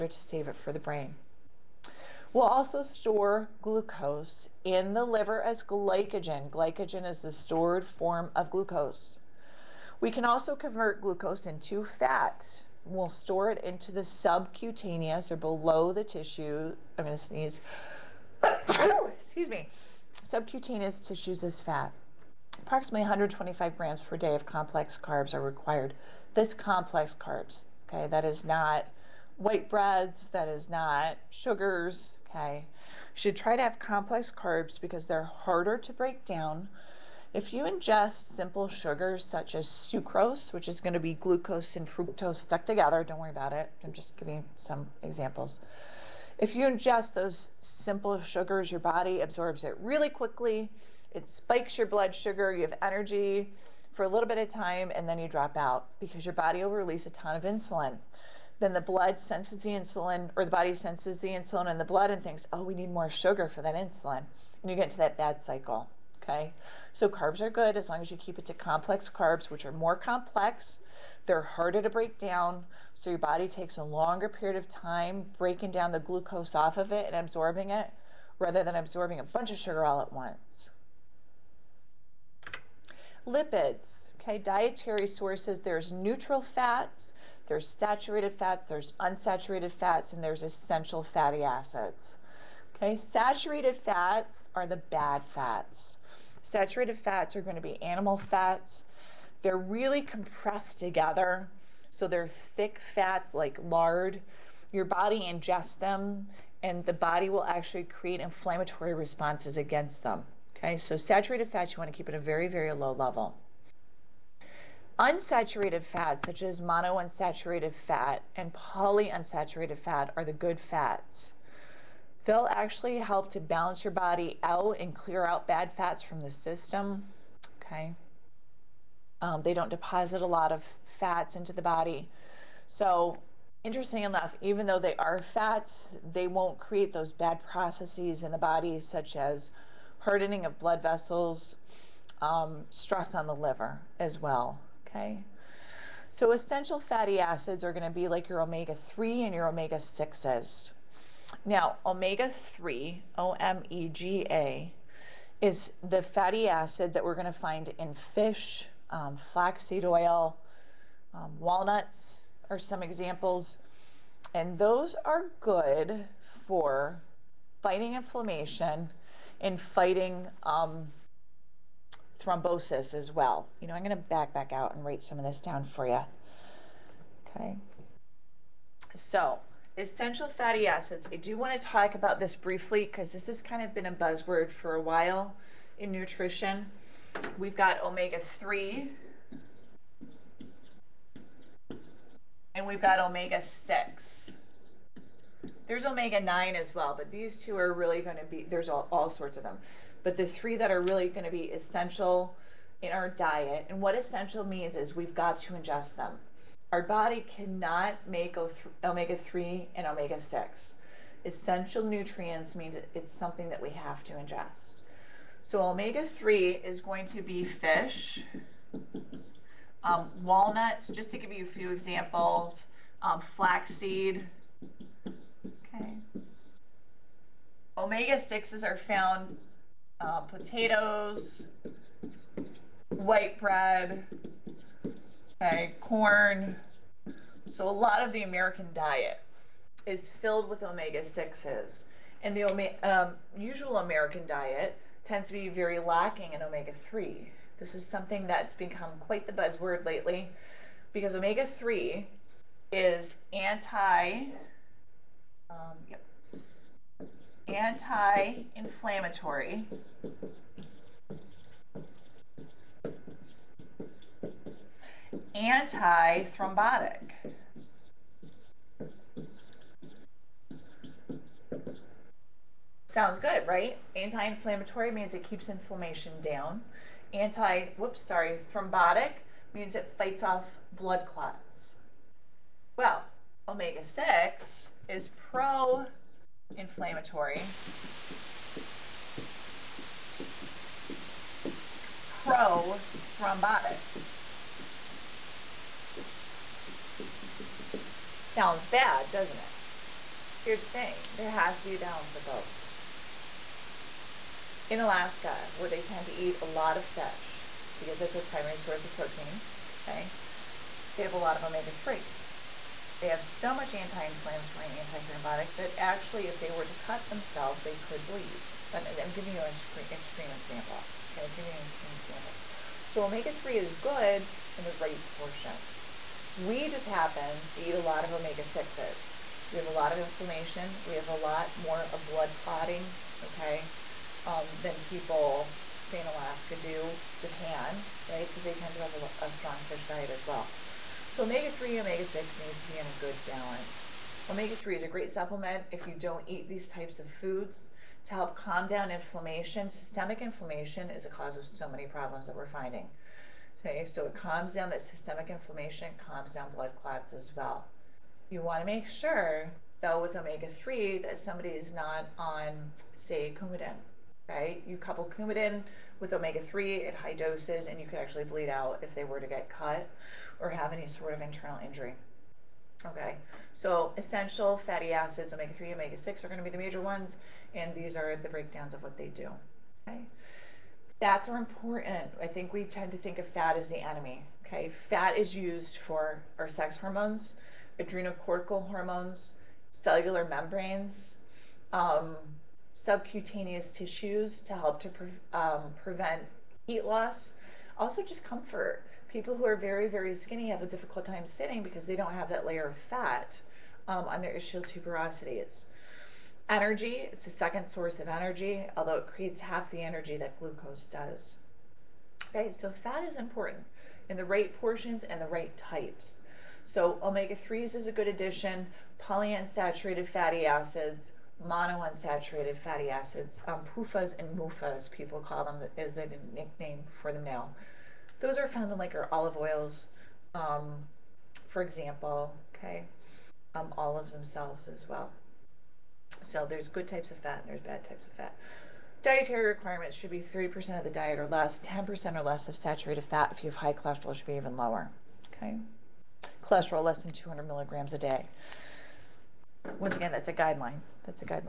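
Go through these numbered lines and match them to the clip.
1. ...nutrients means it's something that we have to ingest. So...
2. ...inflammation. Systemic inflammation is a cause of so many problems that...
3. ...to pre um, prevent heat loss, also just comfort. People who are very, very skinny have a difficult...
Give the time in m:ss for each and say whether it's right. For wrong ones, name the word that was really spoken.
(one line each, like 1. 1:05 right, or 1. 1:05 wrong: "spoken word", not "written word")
1. 3:31 right
2. 5:48 right
3. 6:34 right.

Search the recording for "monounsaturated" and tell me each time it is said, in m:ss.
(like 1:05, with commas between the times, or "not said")
1:56, 7:01.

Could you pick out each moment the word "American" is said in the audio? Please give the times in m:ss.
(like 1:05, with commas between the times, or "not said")
3:58, 4:03.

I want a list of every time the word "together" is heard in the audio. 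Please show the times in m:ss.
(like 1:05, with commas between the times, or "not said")
0:42, 1:40.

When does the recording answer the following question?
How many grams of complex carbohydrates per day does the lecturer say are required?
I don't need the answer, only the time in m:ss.
0:23.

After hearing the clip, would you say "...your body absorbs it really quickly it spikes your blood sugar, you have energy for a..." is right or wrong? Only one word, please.
right.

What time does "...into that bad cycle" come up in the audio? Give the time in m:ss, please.
1:04.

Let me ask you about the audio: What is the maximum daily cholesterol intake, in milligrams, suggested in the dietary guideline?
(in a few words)
200 milligrams.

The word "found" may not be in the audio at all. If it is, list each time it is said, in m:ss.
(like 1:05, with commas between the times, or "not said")
3:48, 7:08.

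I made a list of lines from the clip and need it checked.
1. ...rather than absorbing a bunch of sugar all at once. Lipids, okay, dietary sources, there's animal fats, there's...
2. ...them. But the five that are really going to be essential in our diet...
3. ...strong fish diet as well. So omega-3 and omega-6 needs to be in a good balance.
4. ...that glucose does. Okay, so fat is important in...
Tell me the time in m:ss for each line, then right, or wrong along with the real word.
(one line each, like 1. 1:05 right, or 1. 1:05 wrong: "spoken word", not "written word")
1. 1:18 wrong: "neutral", not "animal"
2. 3:19 wrong: "three", not "five"
3. 5:39 right
4. 6:50 right.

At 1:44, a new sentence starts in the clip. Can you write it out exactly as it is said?
Your body ingests them, and the body will actually create inflammatory responses against them.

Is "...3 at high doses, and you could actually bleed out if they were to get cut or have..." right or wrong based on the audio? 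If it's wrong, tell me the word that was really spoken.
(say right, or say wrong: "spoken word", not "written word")
right.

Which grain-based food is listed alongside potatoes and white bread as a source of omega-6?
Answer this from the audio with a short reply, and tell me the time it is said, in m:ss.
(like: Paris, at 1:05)
Corn, at 3:55.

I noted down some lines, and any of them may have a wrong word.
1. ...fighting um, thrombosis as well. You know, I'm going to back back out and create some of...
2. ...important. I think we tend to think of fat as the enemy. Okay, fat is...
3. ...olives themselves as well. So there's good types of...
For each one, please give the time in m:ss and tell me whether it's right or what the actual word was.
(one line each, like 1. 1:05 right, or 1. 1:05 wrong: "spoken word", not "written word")
1. 2:49 wrong: "write", not "create"
2. 6:21 right
3. 7:13 right.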